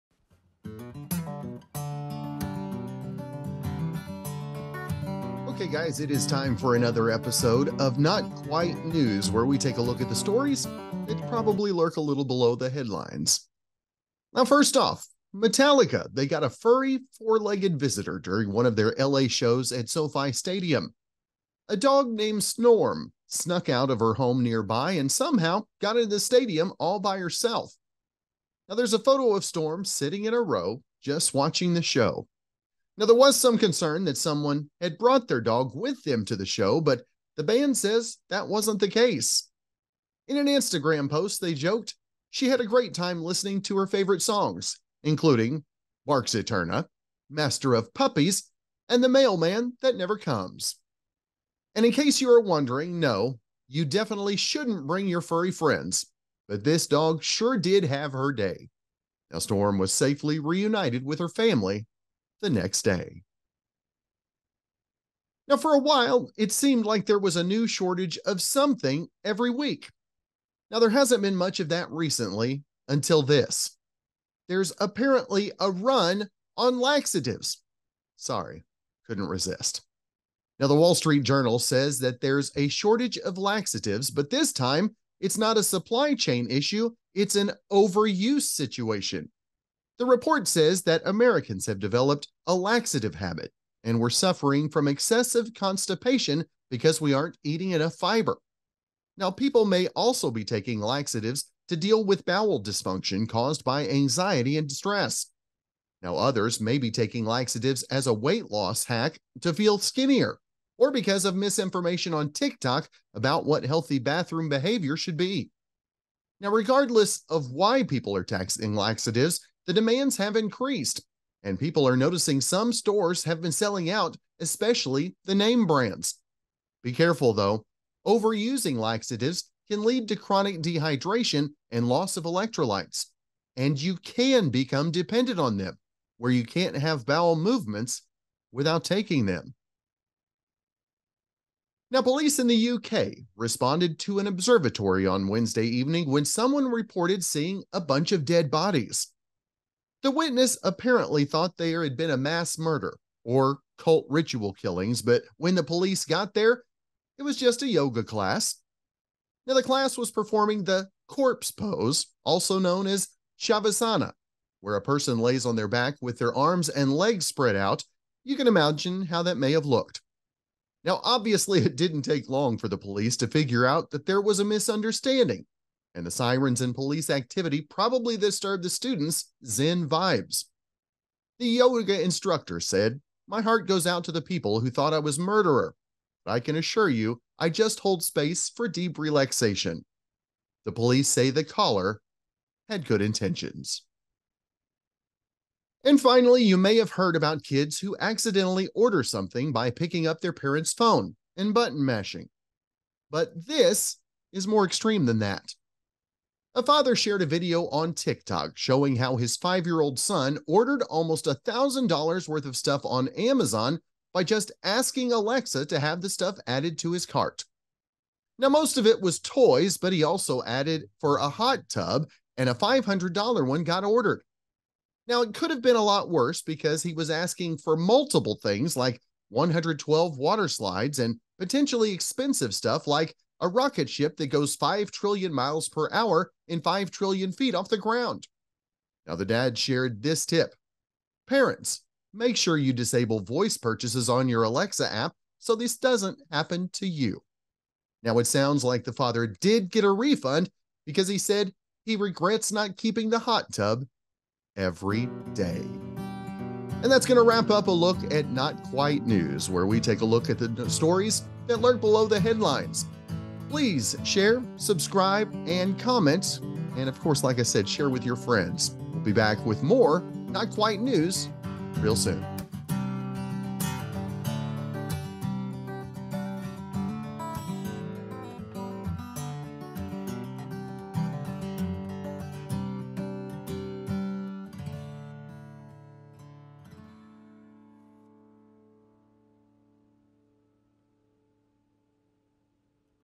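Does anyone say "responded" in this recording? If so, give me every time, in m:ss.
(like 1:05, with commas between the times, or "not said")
2:23.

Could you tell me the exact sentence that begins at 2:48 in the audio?
You can imagine how that may have looked.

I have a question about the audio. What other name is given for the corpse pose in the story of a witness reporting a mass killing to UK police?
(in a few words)
Shavasana.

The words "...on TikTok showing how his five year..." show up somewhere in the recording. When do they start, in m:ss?
3:27.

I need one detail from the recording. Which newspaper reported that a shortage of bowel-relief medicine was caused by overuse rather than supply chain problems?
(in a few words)
Wall Street Journal.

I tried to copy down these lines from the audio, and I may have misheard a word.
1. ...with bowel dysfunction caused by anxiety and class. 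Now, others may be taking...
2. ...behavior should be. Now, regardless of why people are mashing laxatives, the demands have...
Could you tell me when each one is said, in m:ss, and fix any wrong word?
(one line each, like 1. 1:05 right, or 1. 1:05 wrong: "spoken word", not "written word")
1. 1:42 wrong: "distress", not "class"
2. 1:54 wrong: "taxing", not "mashing".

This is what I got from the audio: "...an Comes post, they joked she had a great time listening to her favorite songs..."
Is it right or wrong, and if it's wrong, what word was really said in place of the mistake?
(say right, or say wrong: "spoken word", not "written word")
wrong: "Instagram", not "Comes".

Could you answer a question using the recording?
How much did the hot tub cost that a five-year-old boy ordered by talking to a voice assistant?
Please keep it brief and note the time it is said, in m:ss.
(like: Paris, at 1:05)
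$500, at 3:42.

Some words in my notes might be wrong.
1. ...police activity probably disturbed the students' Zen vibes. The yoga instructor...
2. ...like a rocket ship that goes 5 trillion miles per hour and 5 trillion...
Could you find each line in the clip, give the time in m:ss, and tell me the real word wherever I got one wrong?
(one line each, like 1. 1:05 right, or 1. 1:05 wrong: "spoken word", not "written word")
1. 2:56 right
2. 3:52 right.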